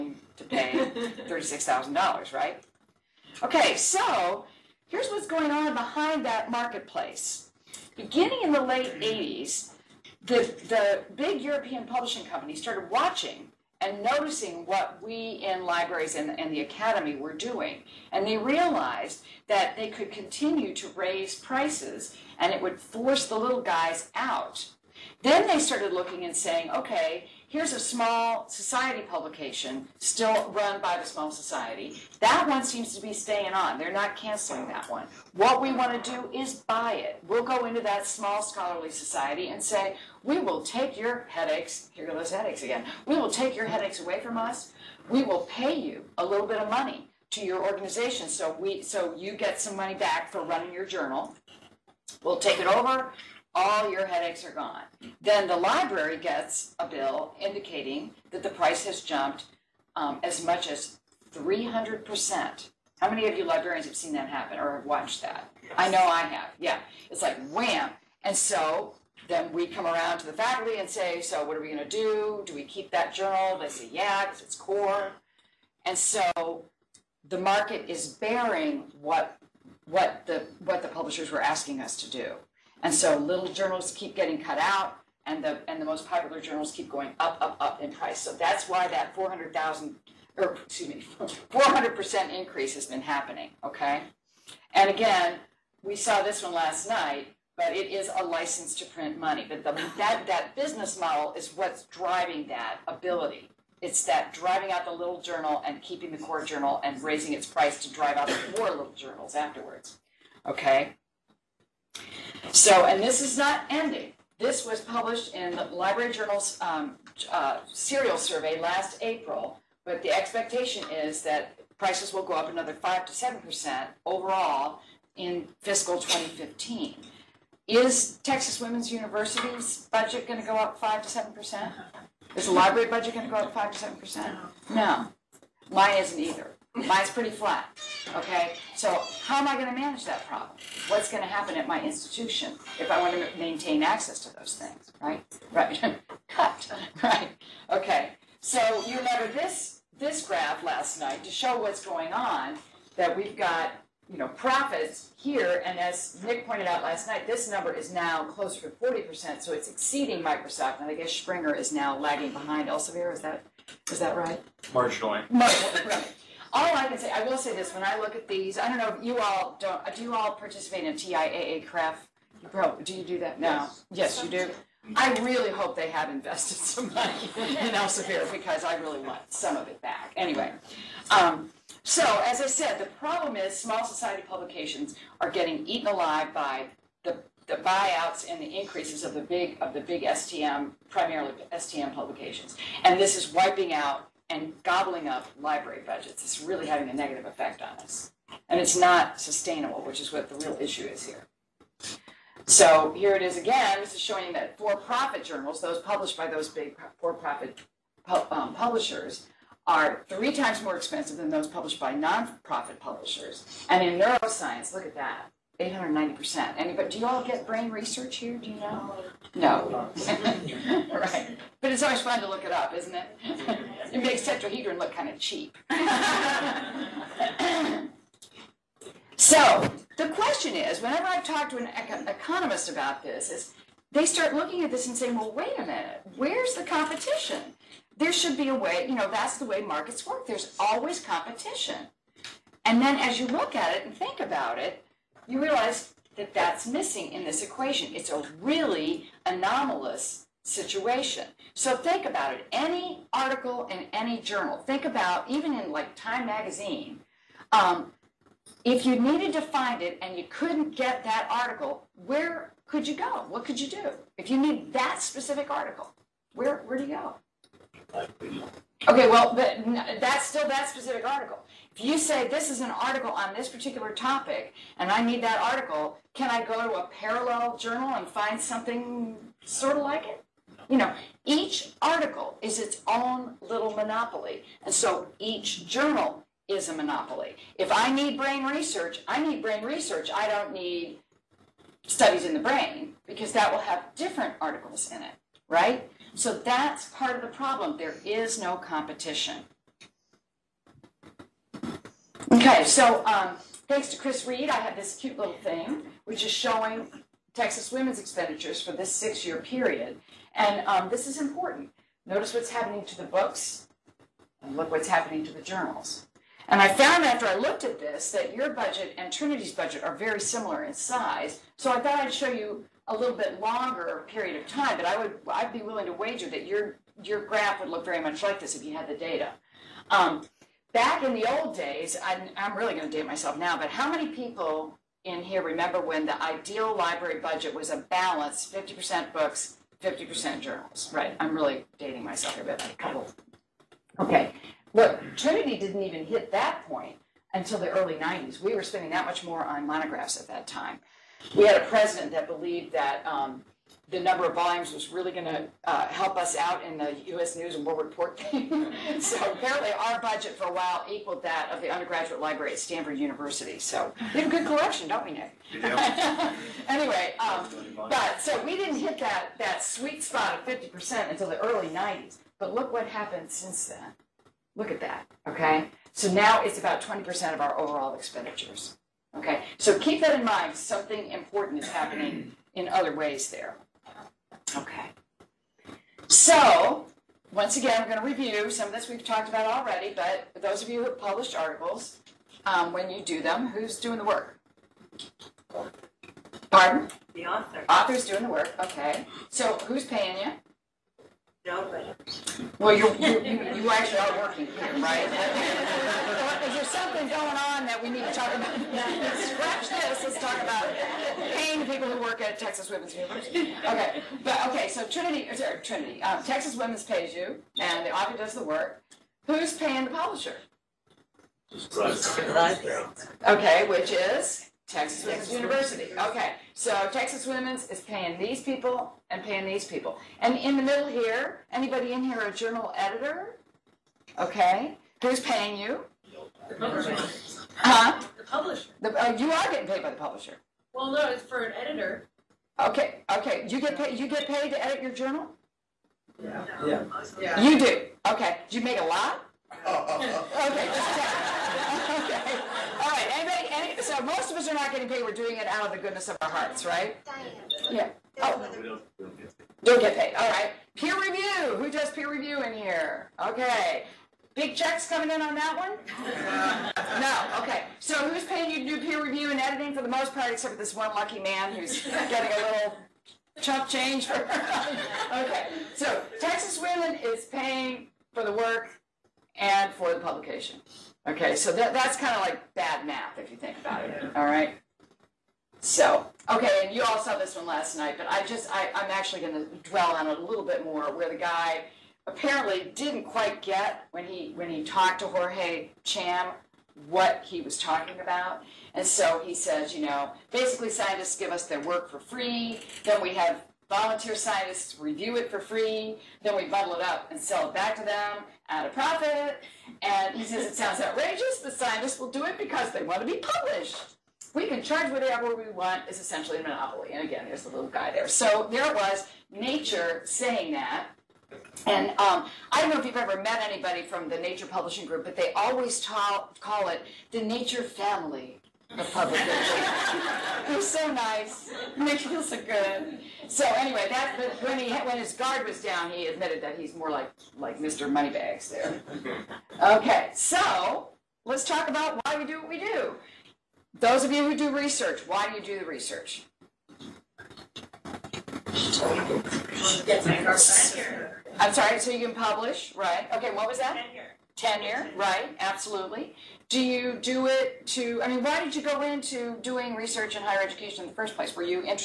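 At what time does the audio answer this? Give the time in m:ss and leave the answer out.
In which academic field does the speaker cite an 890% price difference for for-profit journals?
3:33.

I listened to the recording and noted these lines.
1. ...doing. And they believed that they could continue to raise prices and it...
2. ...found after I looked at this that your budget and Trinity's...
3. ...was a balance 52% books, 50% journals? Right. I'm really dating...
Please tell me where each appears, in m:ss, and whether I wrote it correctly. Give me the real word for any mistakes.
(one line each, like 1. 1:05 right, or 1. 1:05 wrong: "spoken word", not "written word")
1. 0:17 wrong: "realized", not "believed"
2. 5:16 right
3. 5:37 wrong: "50", not "52".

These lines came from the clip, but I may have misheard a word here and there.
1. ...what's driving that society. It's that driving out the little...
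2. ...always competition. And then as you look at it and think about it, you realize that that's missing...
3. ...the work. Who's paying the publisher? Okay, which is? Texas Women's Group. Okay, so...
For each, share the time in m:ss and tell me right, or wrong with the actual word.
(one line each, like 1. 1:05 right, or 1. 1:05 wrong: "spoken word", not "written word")
1. 1:41 wrong: "ability", not "society"
2. 4:00 right
3. 6:58 wrong: "University", not "Group".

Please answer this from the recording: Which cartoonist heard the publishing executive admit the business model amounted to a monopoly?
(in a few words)
Jorge Cham.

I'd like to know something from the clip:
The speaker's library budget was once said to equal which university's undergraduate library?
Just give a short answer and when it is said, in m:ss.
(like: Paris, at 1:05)
Stanford University, at 6:02.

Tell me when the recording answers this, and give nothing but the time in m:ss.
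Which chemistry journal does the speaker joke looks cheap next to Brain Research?
3:44.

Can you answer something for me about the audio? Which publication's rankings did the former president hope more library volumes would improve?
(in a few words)
U.S. News and World Report.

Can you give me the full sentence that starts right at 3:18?
And it's not sustainable, which is what the real issue is here.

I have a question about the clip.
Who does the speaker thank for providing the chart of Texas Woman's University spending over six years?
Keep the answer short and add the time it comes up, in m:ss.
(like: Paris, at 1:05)
Chris Reed, at 5:03.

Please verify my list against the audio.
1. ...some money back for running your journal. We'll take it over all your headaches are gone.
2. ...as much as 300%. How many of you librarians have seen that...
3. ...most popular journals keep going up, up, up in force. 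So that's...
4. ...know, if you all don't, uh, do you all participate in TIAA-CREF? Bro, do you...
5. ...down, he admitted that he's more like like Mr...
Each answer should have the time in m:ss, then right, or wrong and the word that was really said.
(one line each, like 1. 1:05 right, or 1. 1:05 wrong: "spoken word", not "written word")
1. 0:49 right
2. 1:00 right
3. 1:25 wrong: "price", not "force"
4. 2:48 right
5. 8:55 right.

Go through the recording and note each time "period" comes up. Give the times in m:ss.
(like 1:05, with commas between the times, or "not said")
5:09, 5:24.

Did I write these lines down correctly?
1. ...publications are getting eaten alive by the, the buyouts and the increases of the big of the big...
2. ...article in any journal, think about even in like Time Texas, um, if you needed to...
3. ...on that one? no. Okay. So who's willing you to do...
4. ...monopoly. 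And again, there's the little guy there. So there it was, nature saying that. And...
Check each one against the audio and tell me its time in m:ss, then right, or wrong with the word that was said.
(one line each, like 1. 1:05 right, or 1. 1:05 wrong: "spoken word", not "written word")
1. 3:04 right
2. 4:13 wrong: "Magazine", not "Texas"
3. 7:45 wrong: "paying", not "willing"
4. 8:36 right.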